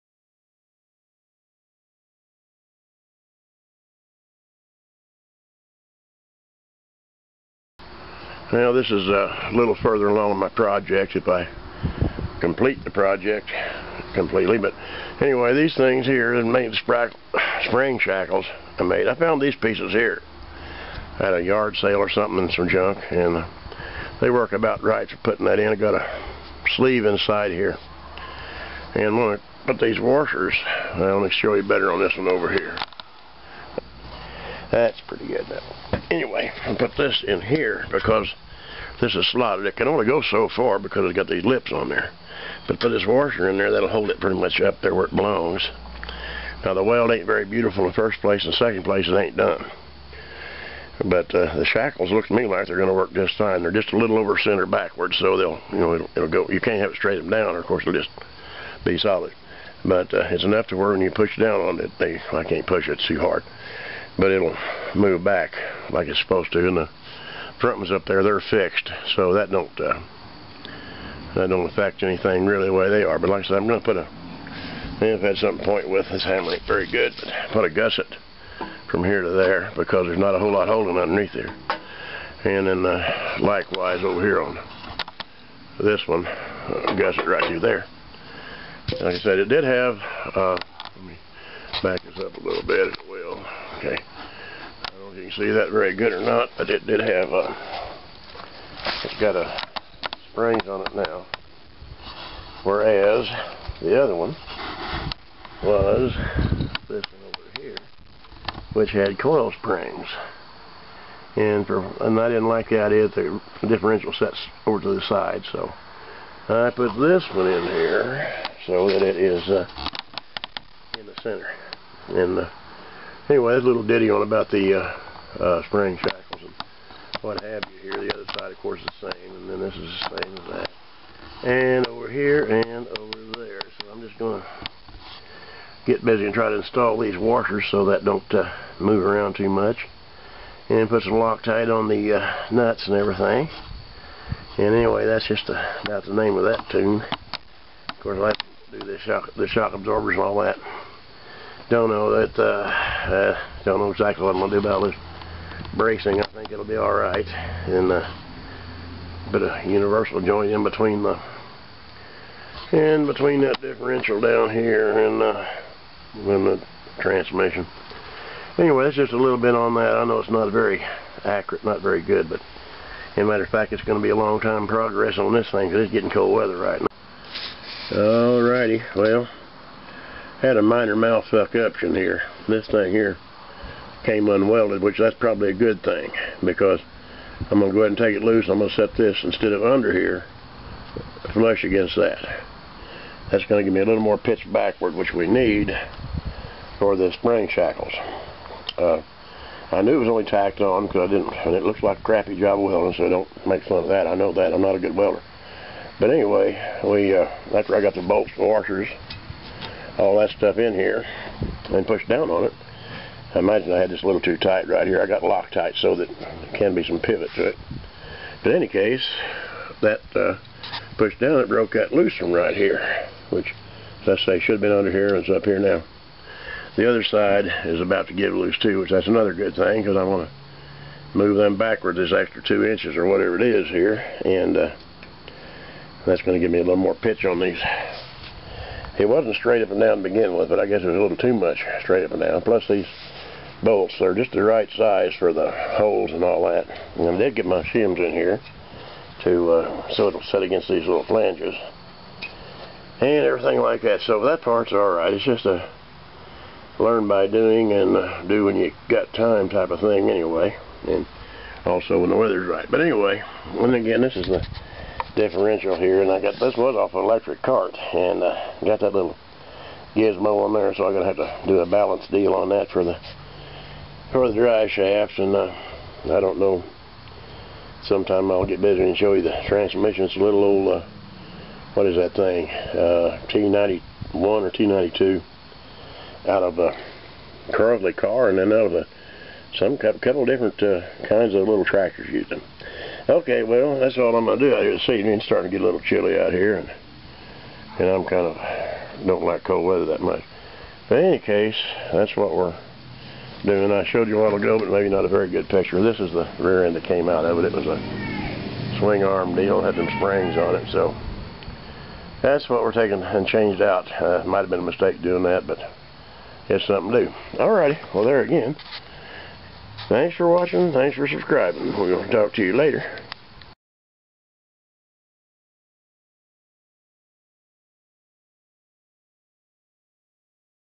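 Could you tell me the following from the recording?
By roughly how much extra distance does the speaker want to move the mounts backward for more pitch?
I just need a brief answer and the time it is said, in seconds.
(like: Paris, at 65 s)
2 inches, at 232 s.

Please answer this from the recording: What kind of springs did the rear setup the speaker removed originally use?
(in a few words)
Coil springs.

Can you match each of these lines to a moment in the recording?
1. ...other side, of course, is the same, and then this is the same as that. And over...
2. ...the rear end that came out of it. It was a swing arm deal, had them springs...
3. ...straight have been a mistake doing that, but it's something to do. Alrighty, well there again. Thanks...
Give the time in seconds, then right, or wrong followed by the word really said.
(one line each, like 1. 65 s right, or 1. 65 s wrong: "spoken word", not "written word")
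1. 128 s right
2. 306 s right
3. 314 s wrong: "might", not "straight".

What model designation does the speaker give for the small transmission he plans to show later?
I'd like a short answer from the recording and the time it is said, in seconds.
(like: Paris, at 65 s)
T91 or T92, at 283 s.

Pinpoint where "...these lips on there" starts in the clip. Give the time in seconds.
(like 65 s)
41 s.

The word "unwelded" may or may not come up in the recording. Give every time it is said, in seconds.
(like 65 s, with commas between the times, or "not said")
184 s.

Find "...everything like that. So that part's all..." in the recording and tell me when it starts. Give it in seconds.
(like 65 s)
253 s.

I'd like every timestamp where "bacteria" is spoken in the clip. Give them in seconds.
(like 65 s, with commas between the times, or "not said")
not said.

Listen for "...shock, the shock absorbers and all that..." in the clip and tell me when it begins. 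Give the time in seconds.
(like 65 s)
148 s.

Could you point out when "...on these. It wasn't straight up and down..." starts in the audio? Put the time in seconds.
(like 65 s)
237 s.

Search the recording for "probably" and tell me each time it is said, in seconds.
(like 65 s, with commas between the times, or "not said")
185 s.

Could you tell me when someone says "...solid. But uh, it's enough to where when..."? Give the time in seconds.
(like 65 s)
58 s.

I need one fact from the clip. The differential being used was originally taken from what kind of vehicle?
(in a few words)
An electric cart.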